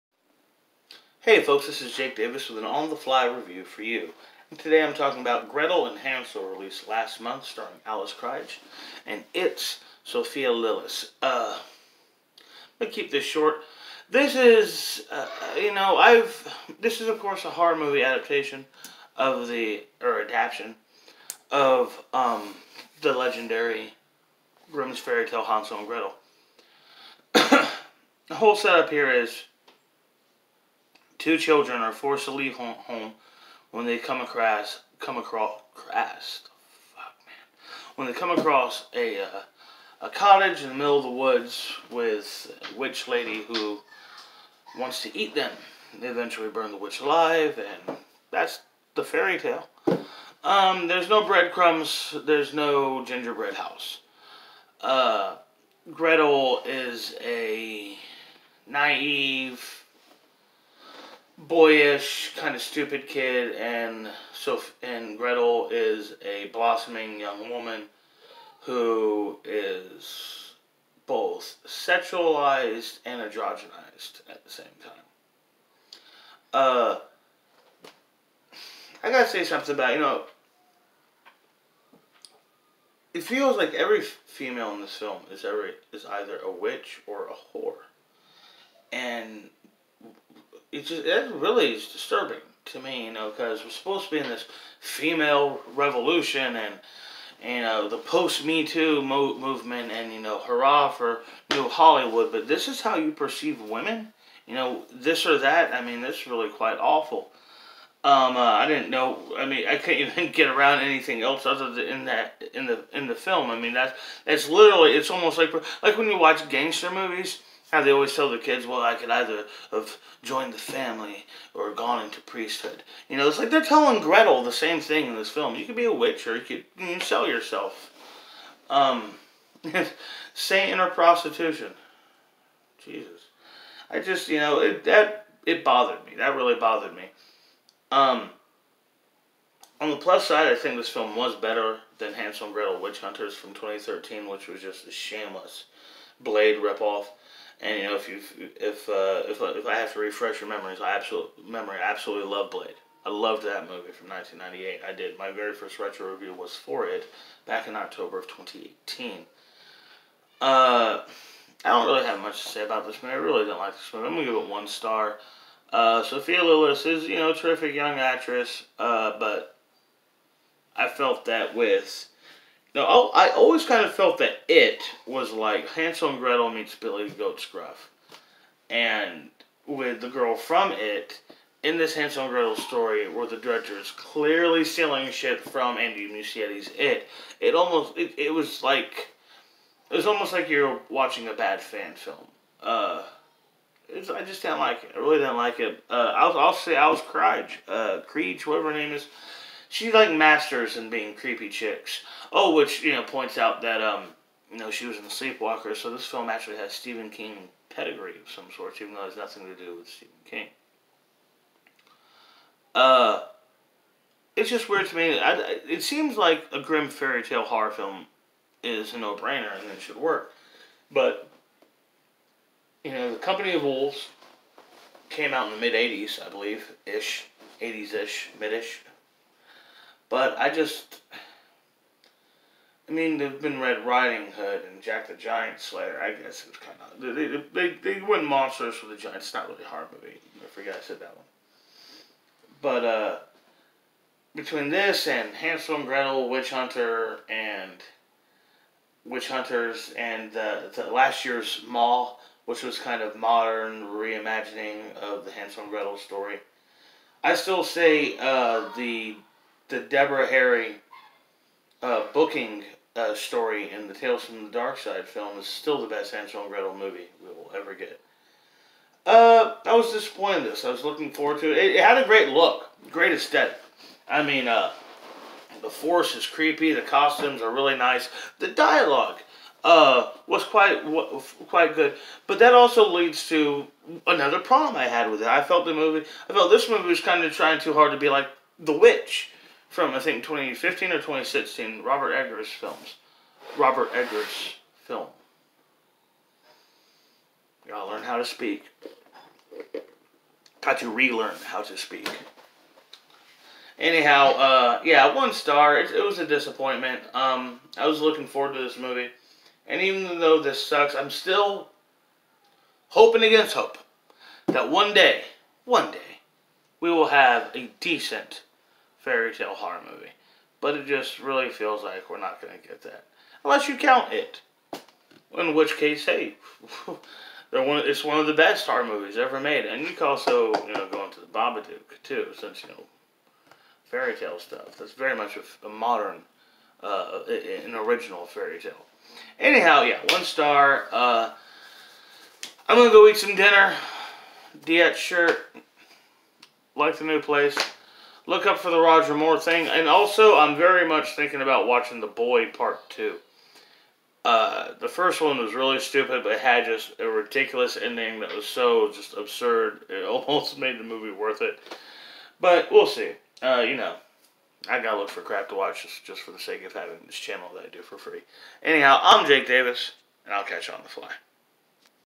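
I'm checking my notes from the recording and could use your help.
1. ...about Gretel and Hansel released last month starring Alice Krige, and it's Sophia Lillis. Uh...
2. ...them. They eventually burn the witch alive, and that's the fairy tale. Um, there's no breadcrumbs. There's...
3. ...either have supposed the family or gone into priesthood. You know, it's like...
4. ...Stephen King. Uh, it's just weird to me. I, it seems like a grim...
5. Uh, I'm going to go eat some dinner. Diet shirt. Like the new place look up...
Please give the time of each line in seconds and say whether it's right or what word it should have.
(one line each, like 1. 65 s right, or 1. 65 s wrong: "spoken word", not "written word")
1. 5 s right
2. 45 s right
3. 119 s wrong: "joined", not "supposed"
4. 209 s right
5. 340 s right.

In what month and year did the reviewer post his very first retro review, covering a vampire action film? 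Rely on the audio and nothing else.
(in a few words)
October 2018.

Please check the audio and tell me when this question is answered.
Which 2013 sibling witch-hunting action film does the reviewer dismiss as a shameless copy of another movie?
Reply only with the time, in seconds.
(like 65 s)
142 s.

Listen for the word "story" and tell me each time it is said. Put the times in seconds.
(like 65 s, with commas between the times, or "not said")
182 s, 255 s, 263 s.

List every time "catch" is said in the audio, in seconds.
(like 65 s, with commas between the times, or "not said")
370 s.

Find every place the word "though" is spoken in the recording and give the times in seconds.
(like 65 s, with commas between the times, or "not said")
208 s, 310 s.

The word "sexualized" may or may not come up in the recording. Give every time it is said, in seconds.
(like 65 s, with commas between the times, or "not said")
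71 s.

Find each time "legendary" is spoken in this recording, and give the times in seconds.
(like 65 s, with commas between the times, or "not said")
23 s.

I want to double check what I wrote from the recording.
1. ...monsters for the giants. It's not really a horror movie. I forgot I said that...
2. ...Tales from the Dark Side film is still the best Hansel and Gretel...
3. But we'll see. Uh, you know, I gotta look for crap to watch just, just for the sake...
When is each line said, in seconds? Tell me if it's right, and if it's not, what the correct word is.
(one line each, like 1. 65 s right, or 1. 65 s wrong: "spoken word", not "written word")
1. 238 s right
2. 263 s right
3. 362 s right.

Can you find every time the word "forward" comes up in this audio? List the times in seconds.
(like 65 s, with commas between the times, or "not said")
271 s, 308 s.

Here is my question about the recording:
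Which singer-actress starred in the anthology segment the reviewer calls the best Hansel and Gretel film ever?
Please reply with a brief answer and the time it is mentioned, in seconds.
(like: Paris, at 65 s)
Deborah Harry, at 259 s.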